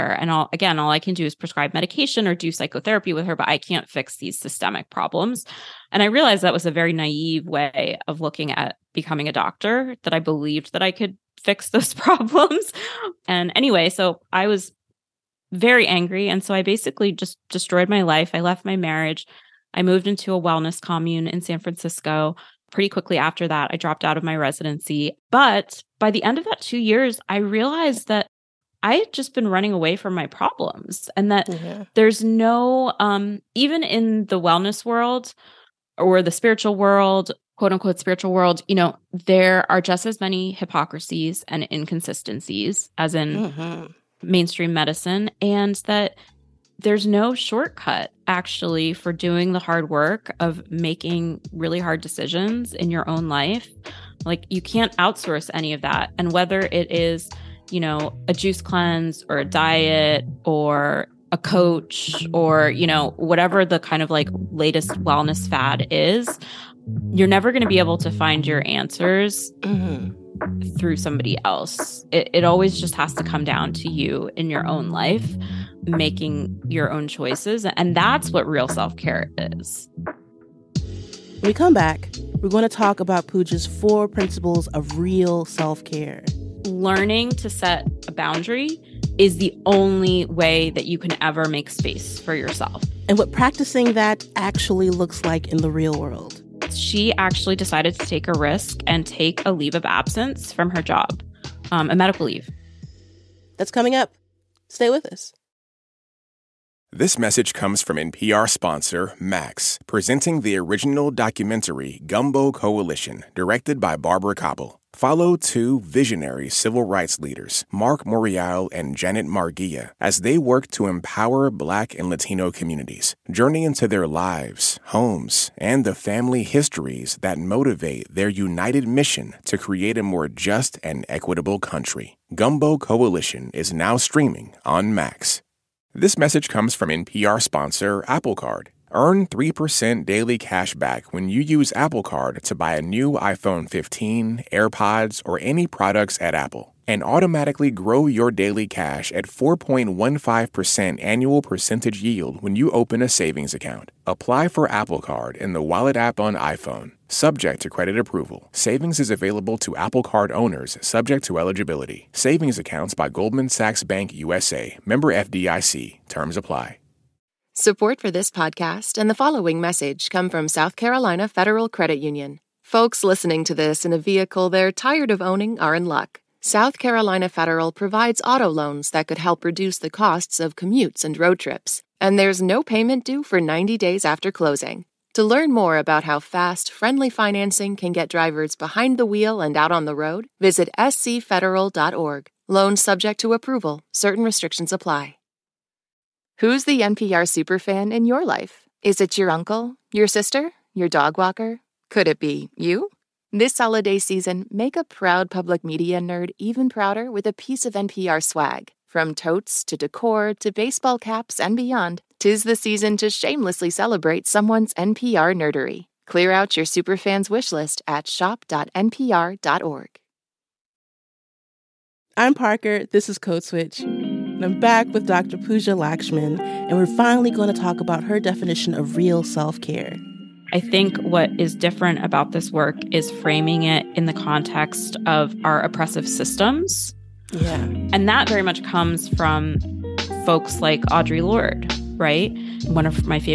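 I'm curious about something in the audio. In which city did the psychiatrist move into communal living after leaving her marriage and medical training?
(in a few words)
San Francisco.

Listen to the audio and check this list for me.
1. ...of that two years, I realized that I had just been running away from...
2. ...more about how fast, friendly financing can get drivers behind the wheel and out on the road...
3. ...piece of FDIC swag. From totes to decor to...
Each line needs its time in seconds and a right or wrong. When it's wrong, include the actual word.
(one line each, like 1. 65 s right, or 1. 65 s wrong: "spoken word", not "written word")
1. 26 s right
2. 185 s right
3. 207 s wrong: "NPR", not "FDIC".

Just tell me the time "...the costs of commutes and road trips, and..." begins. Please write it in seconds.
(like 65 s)
179 s.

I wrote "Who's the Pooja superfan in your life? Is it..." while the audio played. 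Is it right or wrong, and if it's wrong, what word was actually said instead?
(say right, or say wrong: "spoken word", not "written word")
wrong: "NPR", not "Pooja".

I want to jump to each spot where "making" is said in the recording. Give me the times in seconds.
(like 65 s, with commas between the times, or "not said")
50 s, 75 s.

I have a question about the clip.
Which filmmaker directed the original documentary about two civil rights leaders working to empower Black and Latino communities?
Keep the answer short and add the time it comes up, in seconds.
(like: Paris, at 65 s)
Barbara Kopple, at 113 s.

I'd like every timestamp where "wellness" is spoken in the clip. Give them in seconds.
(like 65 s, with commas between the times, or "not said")
20 s, 34 s, 65 s.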